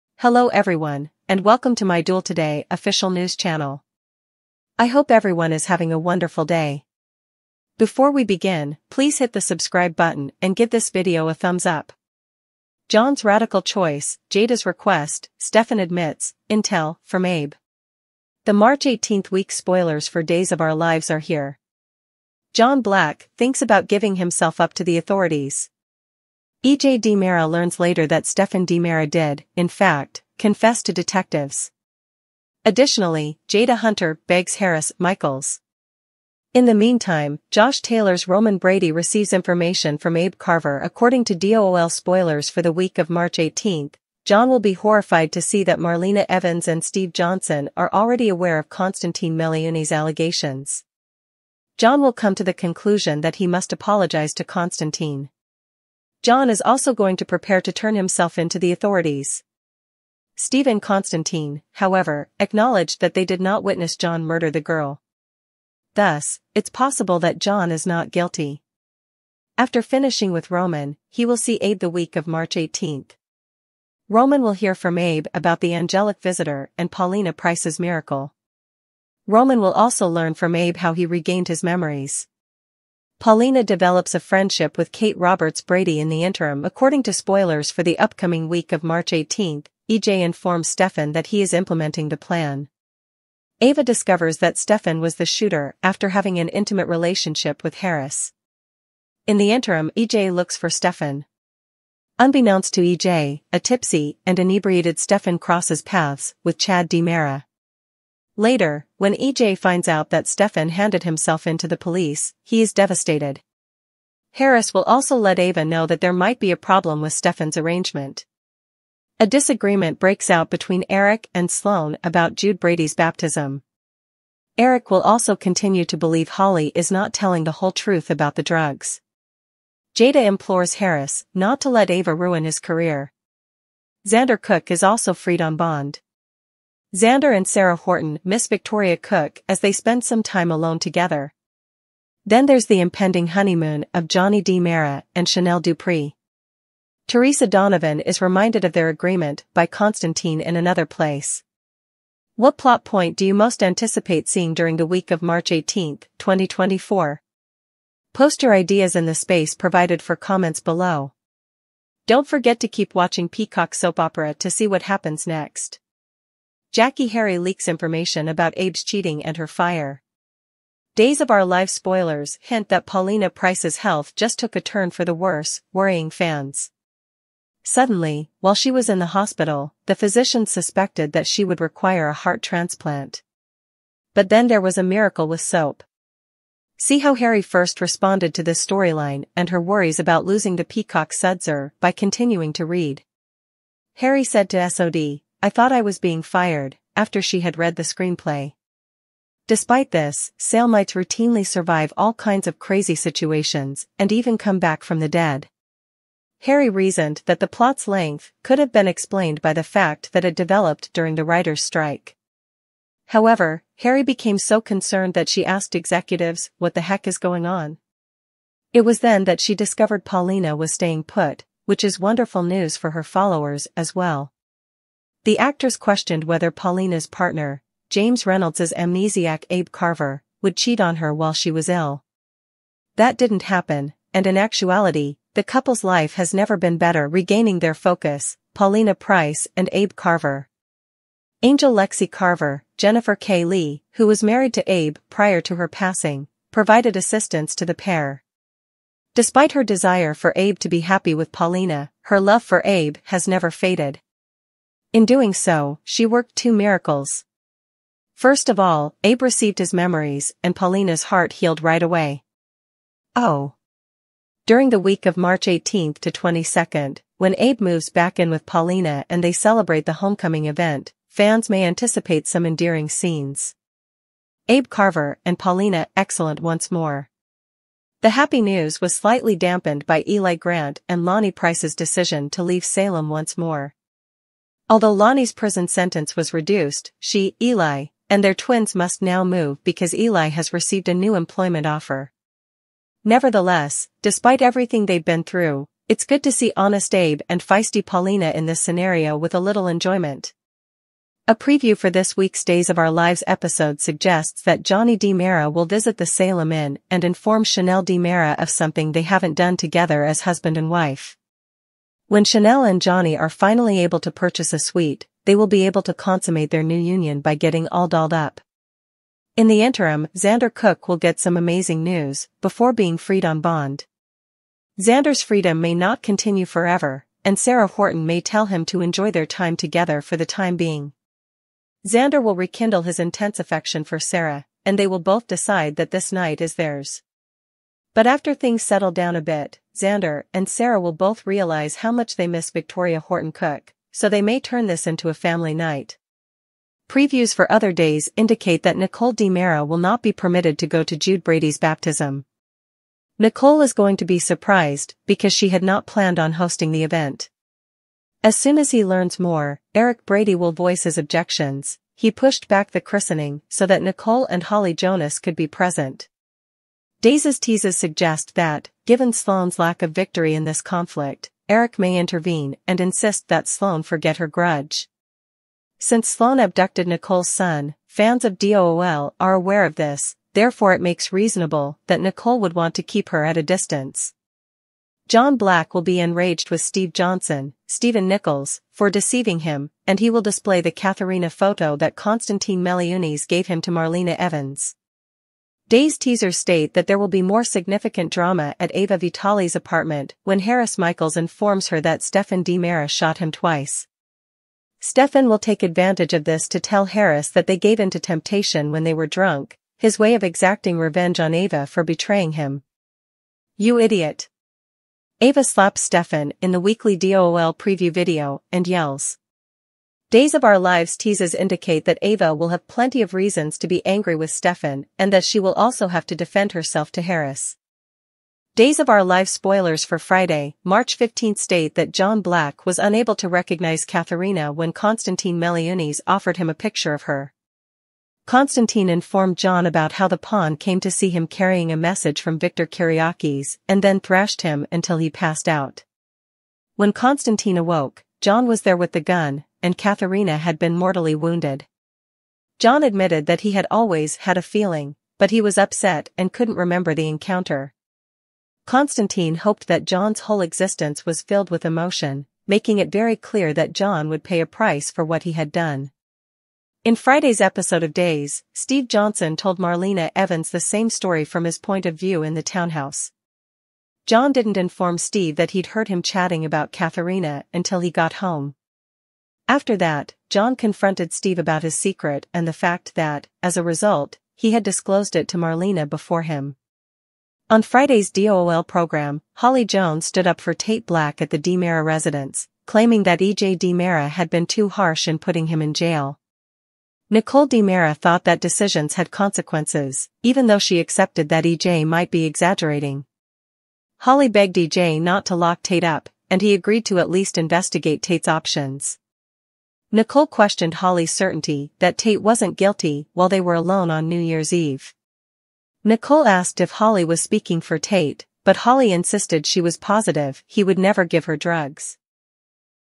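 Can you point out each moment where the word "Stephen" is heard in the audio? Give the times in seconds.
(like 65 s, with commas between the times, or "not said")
60 s, 387 s.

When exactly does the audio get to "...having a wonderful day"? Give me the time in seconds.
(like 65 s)
5 s.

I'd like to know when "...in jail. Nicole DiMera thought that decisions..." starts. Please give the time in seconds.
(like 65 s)
495 s.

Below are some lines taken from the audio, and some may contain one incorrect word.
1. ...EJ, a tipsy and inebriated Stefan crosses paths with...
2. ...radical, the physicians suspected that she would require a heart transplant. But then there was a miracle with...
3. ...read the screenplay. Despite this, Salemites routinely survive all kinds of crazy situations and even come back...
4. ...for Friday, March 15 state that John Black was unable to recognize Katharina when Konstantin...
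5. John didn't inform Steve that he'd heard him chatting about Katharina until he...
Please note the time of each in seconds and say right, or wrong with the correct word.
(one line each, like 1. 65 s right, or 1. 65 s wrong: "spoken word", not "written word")
1. 102 s right
2. 179 s wrong: "hospital", not "radical"
3. 197 s right
4. 429 s right
5. 474 s right.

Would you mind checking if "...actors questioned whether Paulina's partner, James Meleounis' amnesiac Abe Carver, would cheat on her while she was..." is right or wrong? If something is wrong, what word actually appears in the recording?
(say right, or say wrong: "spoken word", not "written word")
wrong: "Reynolds", not "Meleounis".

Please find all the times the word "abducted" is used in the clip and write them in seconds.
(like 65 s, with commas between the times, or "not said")
376 s.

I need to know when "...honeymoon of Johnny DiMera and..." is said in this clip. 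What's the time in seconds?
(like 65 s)
143 s.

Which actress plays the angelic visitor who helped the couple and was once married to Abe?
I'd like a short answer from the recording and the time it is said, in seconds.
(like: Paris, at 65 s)
Jennifer K. Lee, at 242 s.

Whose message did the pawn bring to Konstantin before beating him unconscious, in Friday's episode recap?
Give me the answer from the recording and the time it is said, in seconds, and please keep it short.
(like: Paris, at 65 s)
Victor Kiriakis, at 442 s.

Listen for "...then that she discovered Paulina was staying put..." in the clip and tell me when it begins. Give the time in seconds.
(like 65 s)
218 s.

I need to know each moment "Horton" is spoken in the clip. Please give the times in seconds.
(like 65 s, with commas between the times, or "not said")
137 s, 327 s, 342 s.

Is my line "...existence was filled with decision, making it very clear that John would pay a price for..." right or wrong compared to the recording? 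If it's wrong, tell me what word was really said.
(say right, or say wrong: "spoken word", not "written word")
wrong: "emotion", not "decision".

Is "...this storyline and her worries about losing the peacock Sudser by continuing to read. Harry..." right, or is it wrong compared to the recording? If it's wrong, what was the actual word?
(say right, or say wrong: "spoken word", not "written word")
right.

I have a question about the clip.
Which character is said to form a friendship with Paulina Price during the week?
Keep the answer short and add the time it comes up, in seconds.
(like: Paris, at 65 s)
Kate Roberts Brady, at 84 s.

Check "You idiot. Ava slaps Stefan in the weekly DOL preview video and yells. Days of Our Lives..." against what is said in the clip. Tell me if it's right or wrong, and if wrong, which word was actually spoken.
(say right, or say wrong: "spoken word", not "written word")
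right.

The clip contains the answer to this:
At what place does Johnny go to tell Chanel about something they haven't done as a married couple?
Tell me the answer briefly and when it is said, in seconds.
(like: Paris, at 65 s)
Salem Inn, at 306 s.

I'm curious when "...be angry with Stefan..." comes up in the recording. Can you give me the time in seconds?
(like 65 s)
423 s.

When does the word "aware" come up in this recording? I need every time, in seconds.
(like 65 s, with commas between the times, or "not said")
48 s, 379 s.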